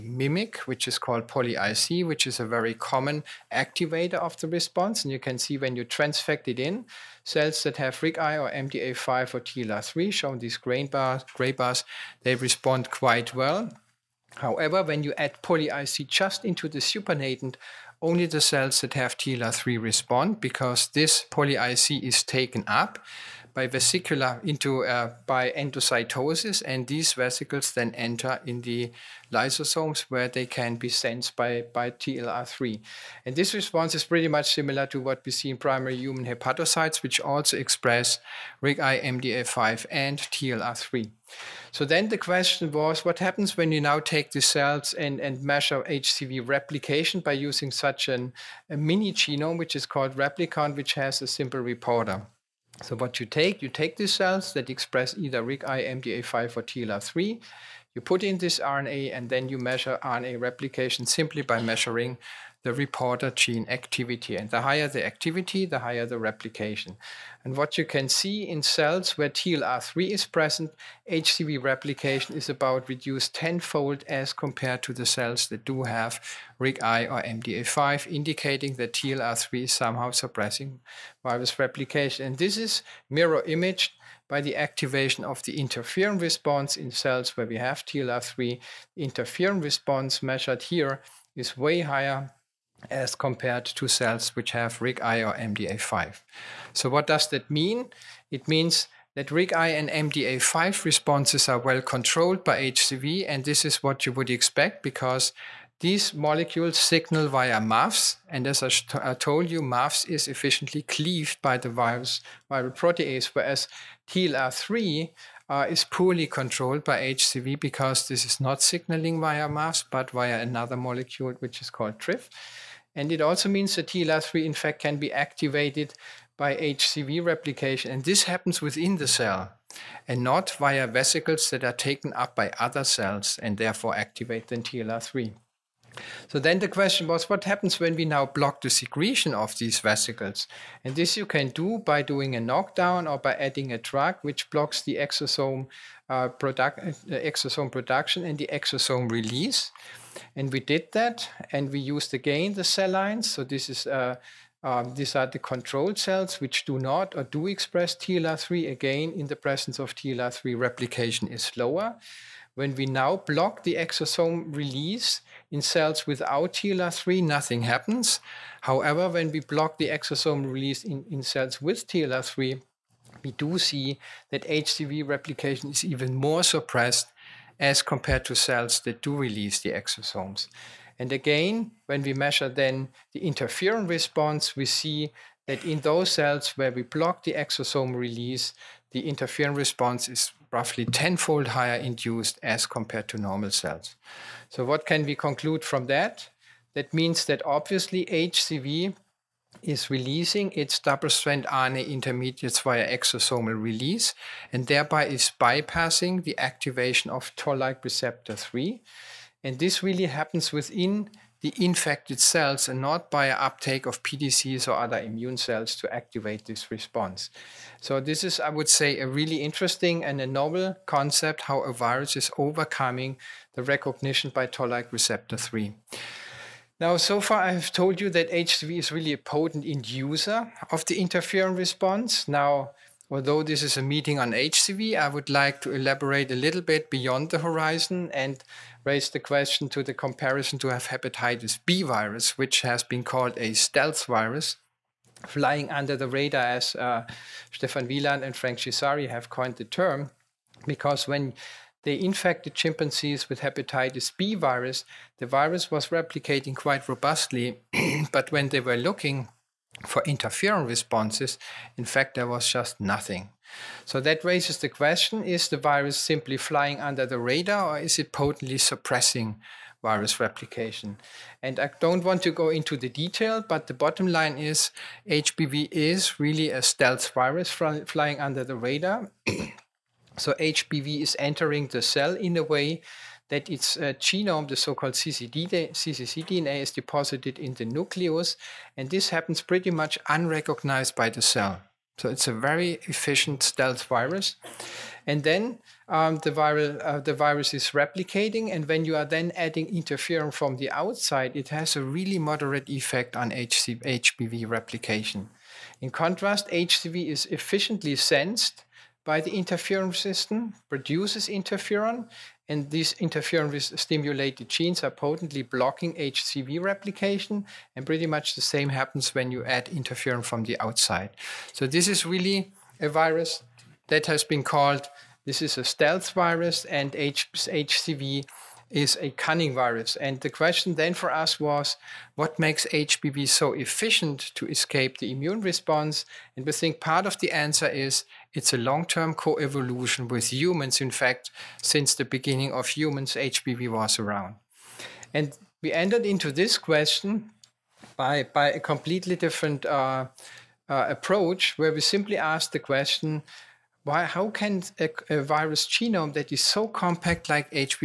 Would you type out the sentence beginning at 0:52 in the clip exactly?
So what you take, you take these cells that express either RIG-I, MDA5, or TLR3.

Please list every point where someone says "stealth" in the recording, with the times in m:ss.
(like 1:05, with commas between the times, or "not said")
4:03, 4:36, 4:53, 5:25.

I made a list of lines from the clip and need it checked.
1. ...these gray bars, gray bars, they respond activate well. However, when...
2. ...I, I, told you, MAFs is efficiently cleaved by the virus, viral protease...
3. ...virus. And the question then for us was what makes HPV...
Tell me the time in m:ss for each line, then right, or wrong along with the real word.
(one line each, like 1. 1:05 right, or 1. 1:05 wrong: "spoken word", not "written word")
1. 0:10 wrong: "quite", not "activate"
2. 1:48 right
3. 5:29 right.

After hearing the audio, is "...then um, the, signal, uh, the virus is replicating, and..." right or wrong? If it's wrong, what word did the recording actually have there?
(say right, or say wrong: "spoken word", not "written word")
wrong: "viral", not "signal".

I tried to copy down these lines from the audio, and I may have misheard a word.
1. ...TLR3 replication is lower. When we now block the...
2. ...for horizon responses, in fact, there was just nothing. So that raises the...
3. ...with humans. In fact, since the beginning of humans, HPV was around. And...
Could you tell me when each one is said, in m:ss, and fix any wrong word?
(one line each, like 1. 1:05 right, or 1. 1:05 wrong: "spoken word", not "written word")
1. 2:39 right
2. 4:19 wrong: "interferon", not "horizon"
3. 5:40 right.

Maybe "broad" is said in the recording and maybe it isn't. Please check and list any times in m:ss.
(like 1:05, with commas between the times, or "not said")
not said.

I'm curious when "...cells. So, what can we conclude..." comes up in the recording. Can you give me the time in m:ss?
3:13.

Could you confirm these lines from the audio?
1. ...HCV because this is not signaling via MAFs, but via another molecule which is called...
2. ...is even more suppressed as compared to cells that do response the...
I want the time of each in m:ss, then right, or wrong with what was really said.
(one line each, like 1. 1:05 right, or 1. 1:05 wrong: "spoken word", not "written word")
1. 1:57 right
2. 2:55 wrong: "release", not "response".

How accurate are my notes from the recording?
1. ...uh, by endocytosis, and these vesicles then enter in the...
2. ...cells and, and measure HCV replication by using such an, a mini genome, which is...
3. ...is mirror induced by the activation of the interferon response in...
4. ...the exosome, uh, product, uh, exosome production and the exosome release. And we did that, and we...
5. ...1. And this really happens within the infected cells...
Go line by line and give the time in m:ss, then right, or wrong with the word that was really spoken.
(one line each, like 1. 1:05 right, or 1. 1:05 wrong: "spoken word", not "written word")
1. 0:24 right
2. 0:44 right
3. 1:22 wrong: "imaged", not "induced"
4. 2:24 right
5. 3:28 wrong: "3", not "1".